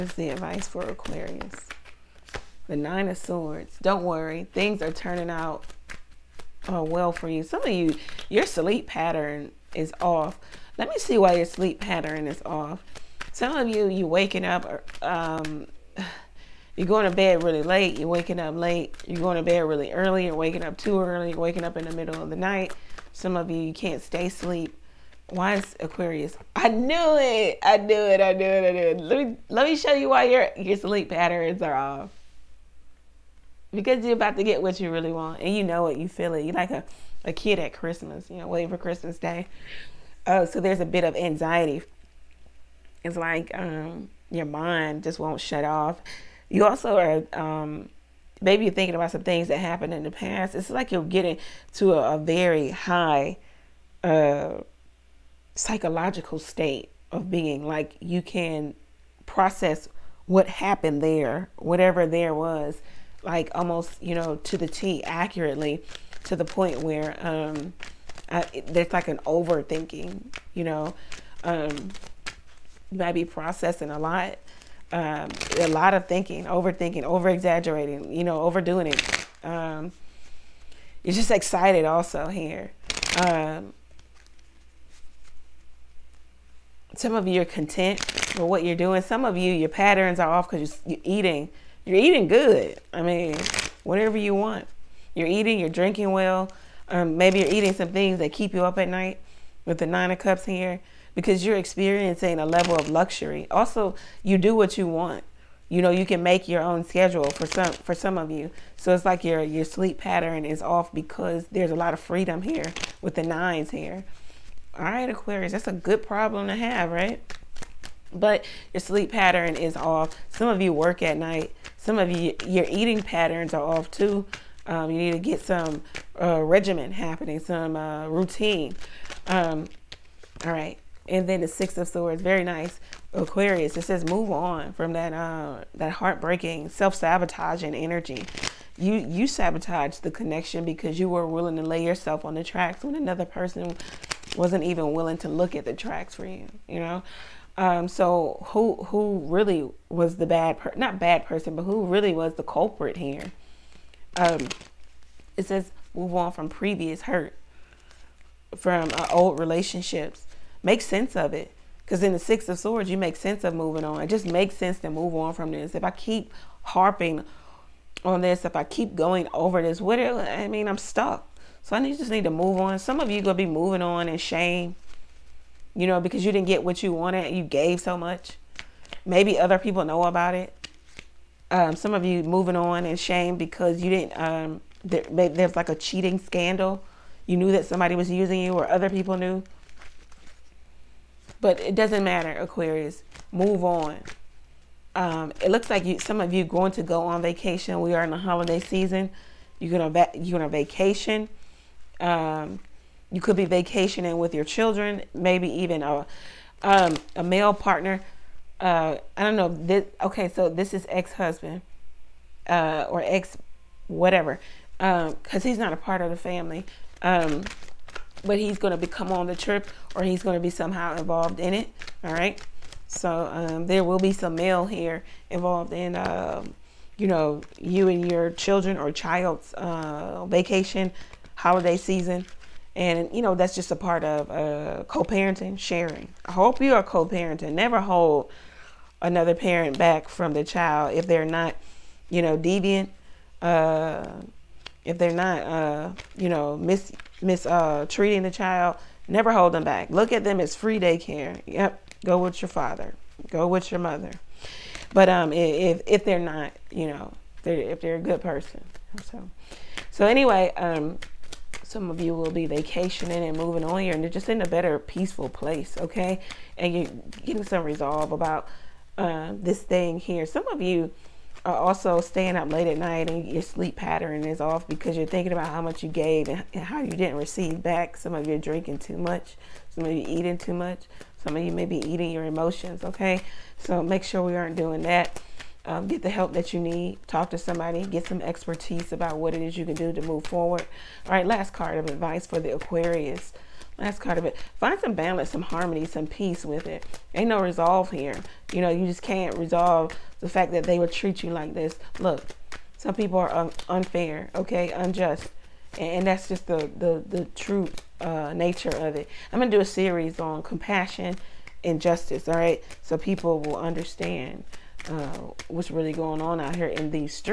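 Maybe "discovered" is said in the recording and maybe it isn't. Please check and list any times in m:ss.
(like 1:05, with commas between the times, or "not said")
not said.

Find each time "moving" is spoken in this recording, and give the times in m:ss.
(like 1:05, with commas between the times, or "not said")
2:43, 2:53, 3:02, 4:23.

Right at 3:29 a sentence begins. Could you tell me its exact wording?
This, okay, so this is ex husband uh, or ex whatever, because um, he's not a part of the family.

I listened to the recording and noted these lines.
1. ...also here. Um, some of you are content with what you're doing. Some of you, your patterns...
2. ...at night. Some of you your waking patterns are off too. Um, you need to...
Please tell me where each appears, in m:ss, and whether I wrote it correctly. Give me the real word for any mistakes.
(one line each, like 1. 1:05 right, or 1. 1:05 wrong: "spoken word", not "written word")
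1. 1:21 right
2. 2:01 wrong: "eating", not "waking".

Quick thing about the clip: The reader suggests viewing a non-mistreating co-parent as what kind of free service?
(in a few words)
Free daycare.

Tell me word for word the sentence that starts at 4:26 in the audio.
And you're getting some resolve about uh, this thing here.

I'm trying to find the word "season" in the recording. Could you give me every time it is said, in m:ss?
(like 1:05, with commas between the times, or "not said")
3:18, 3:51.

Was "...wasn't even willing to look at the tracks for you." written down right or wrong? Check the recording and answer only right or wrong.
right.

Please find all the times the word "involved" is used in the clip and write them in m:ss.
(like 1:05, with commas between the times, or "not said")
3:40, 3:45.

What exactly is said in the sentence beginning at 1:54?
All right, Aquarius, that's a good problem to have, right?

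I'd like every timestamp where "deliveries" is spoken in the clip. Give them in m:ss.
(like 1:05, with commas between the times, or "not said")
not said.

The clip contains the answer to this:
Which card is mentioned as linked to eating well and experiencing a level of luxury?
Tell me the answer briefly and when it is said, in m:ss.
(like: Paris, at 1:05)
Nine of Cups, at 1:39.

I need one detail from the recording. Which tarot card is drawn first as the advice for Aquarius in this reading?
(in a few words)
Nine of Swords.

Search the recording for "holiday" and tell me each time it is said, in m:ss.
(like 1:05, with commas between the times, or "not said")
3:18, 3:51.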